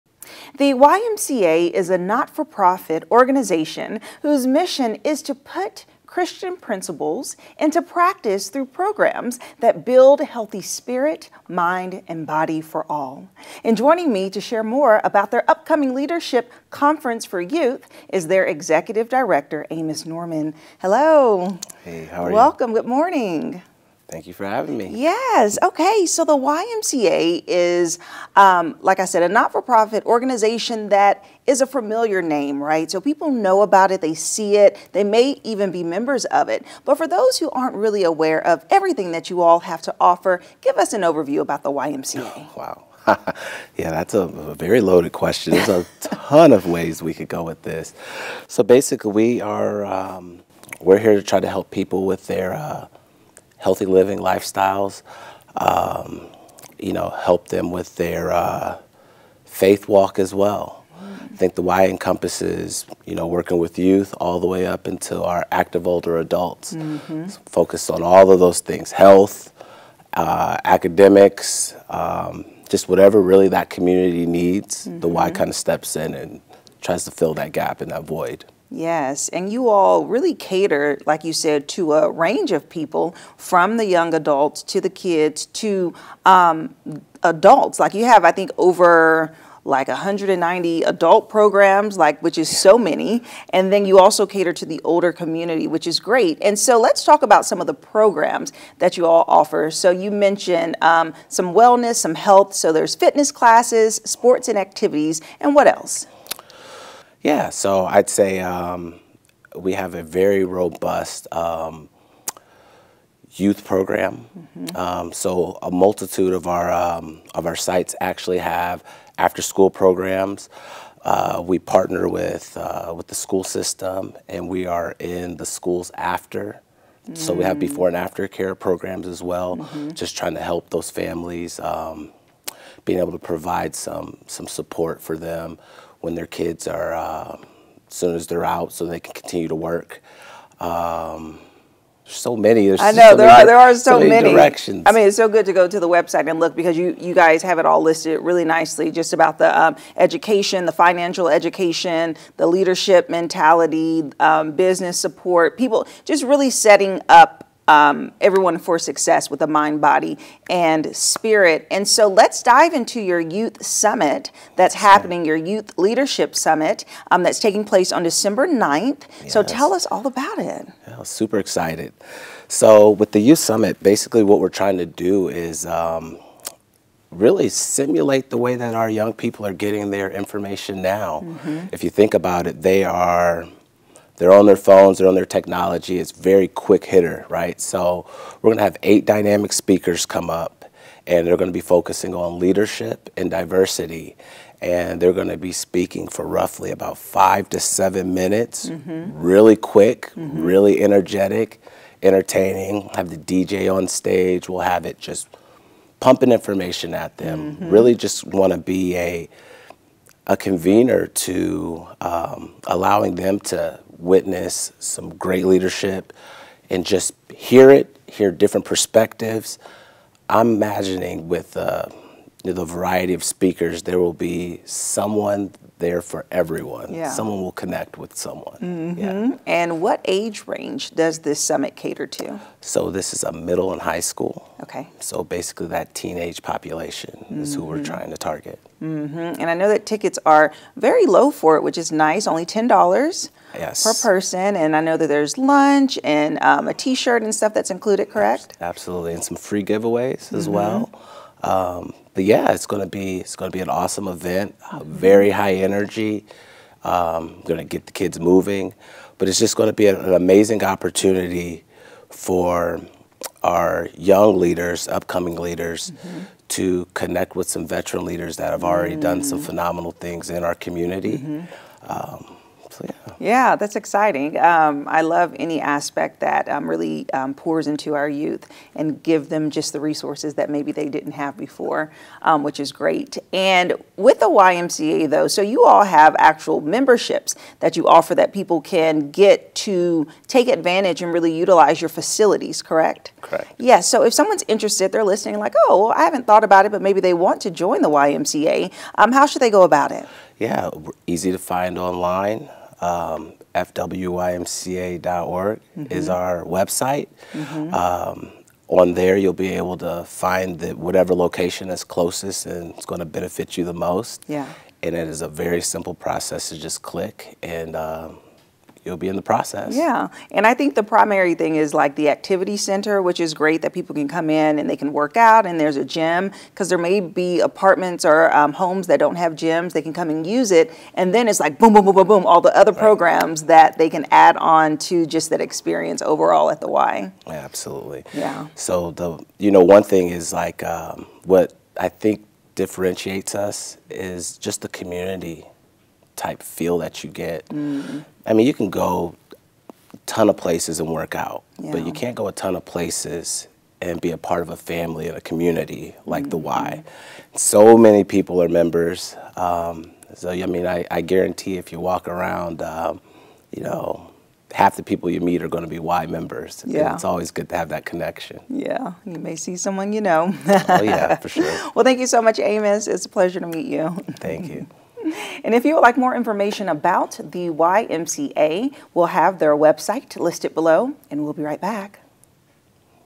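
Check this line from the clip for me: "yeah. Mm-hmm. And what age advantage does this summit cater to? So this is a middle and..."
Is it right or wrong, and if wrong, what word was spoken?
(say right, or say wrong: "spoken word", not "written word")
wrong: "range", not "advantage".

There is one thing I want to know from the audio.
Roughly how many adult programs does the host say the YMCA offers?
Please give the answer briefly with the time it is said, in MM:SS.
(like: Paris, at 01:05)
190, at 01:29.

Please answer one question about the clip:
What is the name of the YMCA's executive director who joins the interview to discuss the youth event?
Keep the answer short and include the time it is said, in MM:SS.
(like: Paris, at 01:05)
Amos Norman, at 00:19.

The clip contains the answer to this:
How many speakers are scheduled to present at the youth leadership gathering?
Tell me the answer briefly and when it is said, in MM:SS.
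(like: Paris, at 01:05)
8, at 03:08.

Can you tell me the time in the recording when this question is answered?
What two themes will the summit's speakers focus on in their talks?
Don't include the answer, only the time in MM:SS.
03:12.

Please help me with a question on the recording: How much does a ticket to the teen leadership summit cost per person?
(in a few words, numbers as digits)
$10.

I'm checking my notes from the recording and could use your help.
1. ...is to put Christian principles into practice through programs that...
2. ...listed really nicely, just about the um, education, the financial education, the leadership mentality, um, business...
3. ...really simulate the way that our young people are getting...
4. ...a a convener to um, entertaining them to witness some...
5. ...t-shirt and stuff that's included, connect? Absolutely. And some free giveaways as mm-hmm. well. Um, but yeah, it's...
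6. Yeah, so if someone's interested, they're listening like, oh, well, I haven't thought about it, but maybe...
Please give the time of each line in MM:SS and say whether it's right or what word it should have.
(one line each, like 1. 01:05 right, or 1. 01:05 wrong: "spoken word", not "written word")
1. 00:05 right
2. 02:27 right
3. 02:57 right
4. 03:28 wrong: "allowing", not "entertaining"
5. 04:06 wrong: "correct", not "connect"
6. 04:53 right.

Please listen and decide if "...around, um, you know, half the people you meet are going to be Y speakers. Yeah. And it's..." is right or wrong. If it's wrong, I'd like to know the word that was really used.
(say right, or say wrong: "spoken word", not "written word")
wrong: "members", not "speakers".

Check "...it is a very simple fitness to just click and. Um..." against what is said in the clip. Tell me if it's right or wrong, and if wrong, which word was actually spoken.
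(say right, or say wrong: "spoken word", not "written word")
wrong: "process", not "fitness".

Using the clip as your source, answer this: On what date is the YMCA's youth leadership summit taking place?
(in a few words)
December 9th.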